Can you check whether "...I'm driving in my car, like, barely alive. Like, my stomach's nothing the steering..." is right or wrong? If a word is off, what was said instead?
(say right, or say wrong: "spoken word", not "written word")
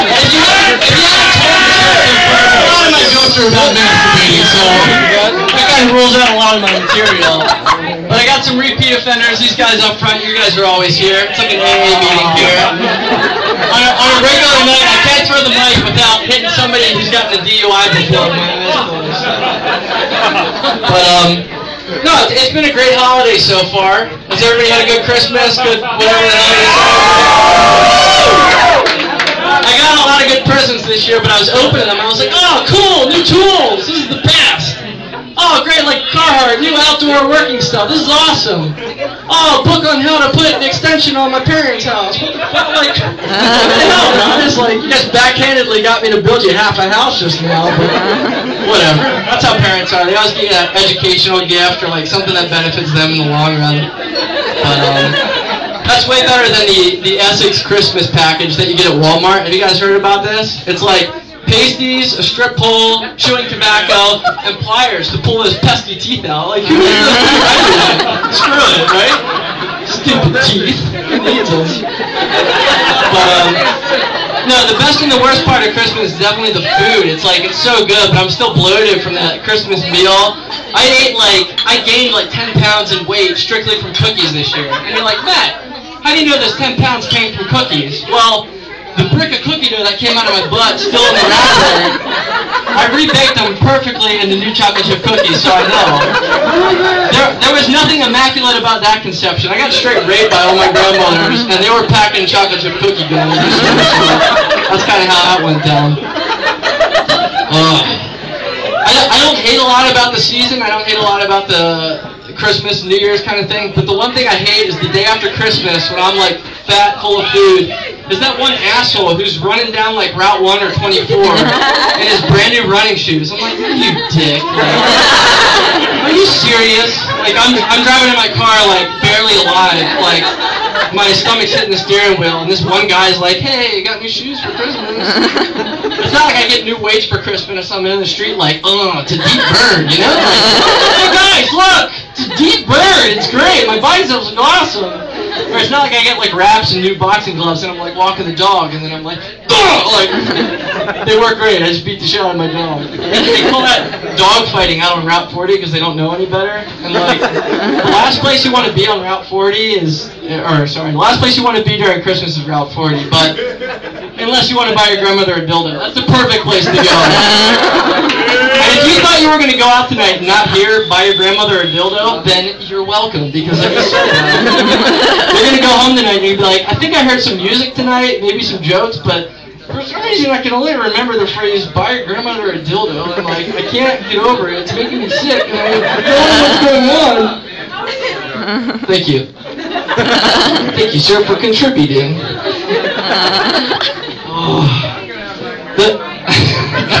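wrong: "hitting", not "nothing".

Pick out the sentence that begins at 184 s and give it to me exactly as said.
It's making me sick and I don't know what's going on.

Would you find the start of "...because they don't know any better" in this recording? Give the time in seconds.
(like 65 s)
155 s.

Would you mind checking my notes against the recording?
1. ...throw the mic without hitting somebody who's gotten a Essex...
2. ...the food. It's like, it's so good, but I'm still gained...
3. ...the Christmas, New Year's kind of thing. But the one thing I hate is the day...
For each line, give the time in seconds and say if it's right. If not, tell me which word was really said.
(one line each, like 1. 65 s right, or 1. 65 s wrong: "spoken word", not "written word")
1. 15 s wrong: "DUI", not "Essex"
2. 76 s wrong: "bloated", not "gained"
3. 111 s right.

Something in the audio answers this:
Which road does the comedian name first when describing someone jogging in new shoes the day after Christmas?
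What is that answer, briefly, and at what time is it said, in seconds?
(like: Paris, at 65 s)
Route 1, at 120 s.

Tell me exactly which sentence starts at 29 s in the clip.
I got a lot of good presents this year, but I was opening them.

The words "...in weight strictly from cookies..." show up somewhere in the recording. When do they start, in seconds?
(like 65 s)
82 s.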